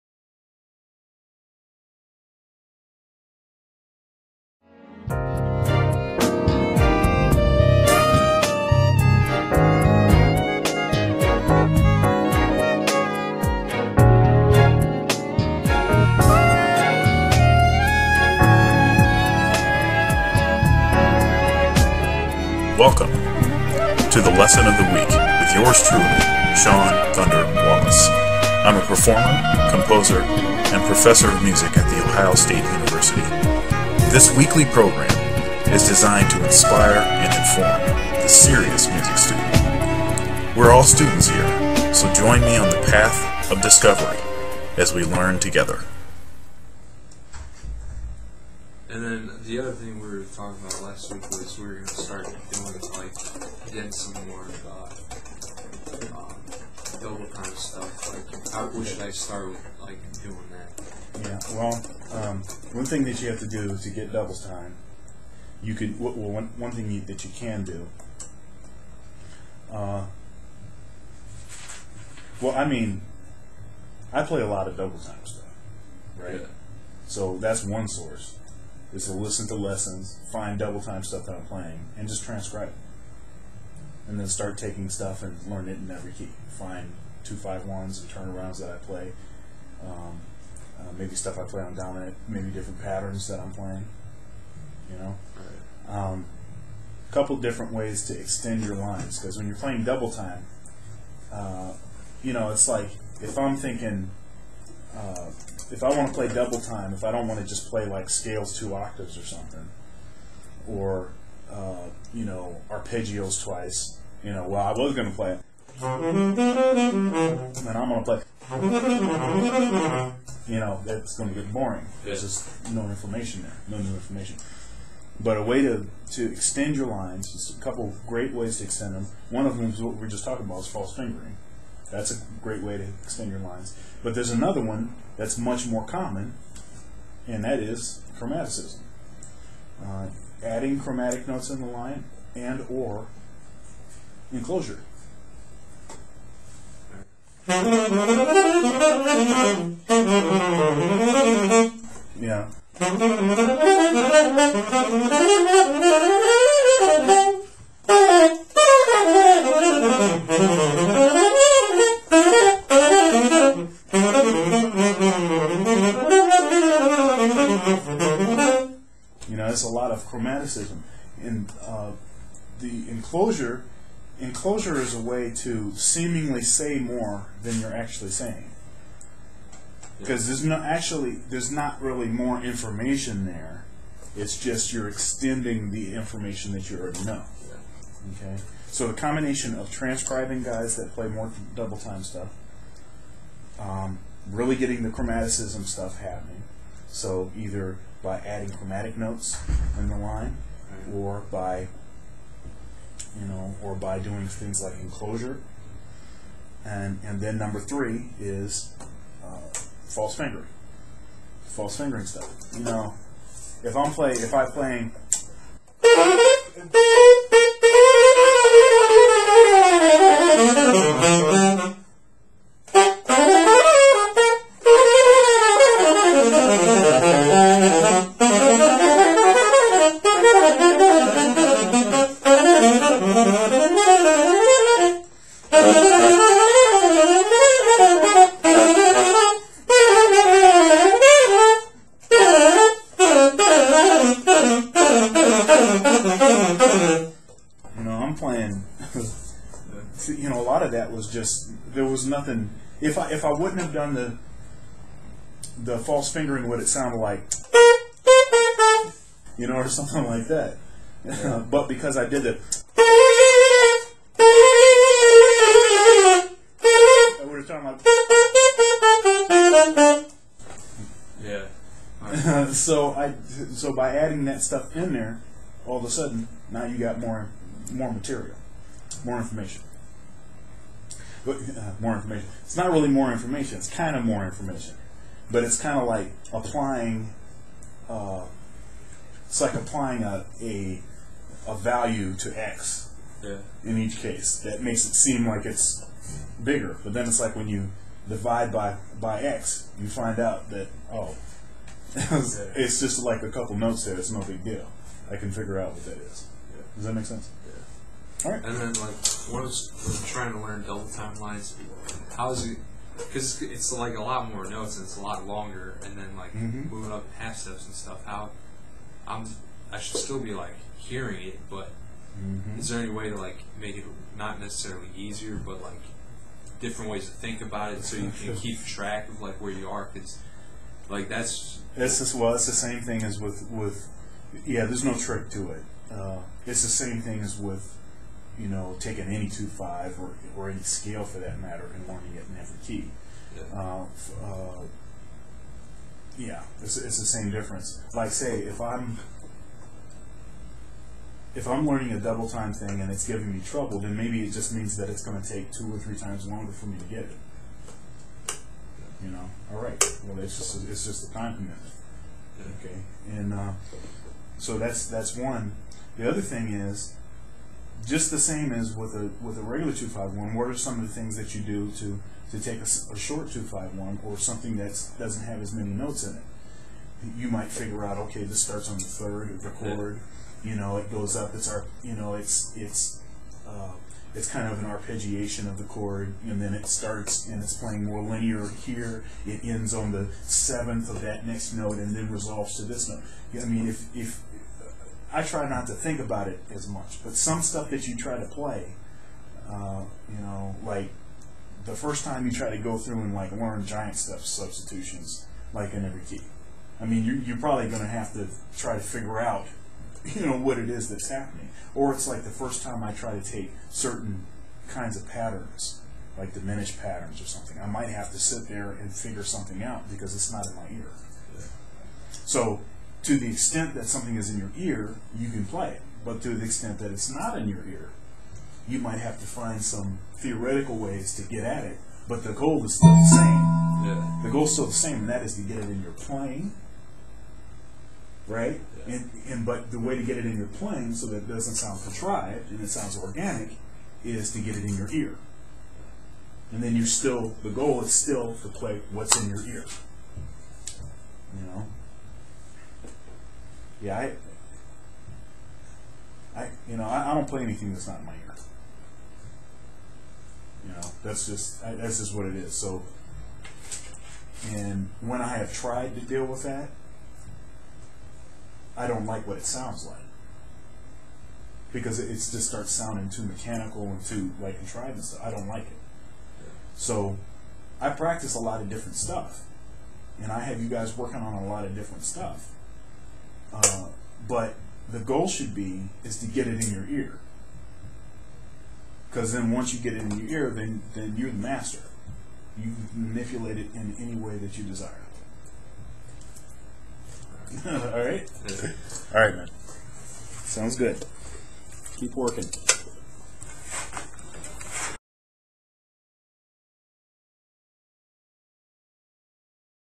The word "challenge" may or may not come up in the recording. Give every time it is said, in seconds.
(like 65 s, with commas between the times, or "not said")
not said.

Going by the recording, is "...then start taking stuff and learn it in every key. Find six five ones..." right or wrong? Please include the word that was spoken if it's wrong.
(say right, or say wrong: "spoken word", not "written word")
wrong: "two", not "six".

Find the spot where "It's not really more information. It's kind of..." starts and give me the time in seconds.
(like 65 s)
282 s.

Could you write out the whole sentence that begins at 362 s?
Okay, and uh, so that's that's one.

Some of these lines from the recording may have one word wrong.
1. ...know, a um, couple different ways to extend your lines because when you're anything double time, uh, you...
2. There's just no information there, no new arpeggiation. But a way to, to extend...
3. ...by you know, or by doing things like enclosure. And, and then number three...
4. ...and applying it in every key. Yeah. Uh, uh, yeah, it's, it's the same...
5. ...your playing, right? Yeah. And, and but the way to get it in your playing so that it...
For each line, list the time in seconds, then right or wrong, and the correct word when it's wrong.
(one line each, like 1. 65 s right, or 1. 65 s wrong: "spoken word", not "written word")
1. 94 s wrong: "playing", not "anything"
2. 122 s wrong: "information", not "arpeggiation"
3. 201 s right
4. 341 s wrong: "learning", not "applying"
5. 435 s right.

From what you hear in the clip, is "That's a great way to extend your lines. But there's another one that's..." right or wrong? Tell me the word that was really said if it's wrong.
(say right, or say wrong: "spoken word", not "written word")
right.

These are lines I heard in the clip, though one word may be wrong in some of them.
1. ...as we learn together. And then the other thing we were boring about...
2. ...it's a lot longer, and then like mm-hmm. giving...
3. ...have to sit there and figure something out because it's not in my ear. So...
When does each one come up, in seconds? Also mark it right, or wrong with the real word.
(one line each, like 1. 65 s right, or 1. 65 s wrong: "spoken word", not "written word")
1. 44 s wrong: "talking", not "boring"
2. 314 s wrong: "moving", not "giving"
3. 417 s right.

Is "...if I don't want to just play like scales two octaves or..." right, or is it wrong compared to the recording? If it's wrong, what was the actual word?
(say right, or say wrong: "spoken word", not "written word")
right.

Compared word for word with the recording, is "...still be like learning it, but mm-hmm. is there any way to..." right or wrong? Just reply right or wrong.
wrong.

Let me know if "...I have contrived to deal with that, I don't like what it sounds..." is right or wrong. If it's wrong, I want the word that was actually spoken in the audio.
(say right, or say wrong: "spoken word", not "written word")
wrong: "tried", not "contrived".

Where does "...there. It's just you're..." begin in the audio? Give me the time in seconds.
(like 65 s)
183 s.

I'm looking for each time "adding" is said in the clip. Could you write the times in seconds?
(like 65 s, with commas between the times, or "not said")
140 s, 198 s, 273 s.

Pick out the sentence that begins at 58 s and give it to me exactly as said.
Like, how, should I start with?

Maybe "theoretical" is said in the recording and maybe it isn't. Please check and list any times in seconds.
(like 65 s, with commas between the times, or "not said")
430 s.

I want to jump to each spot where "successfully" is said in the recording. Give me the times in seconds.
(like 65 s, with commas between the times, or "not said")
not said.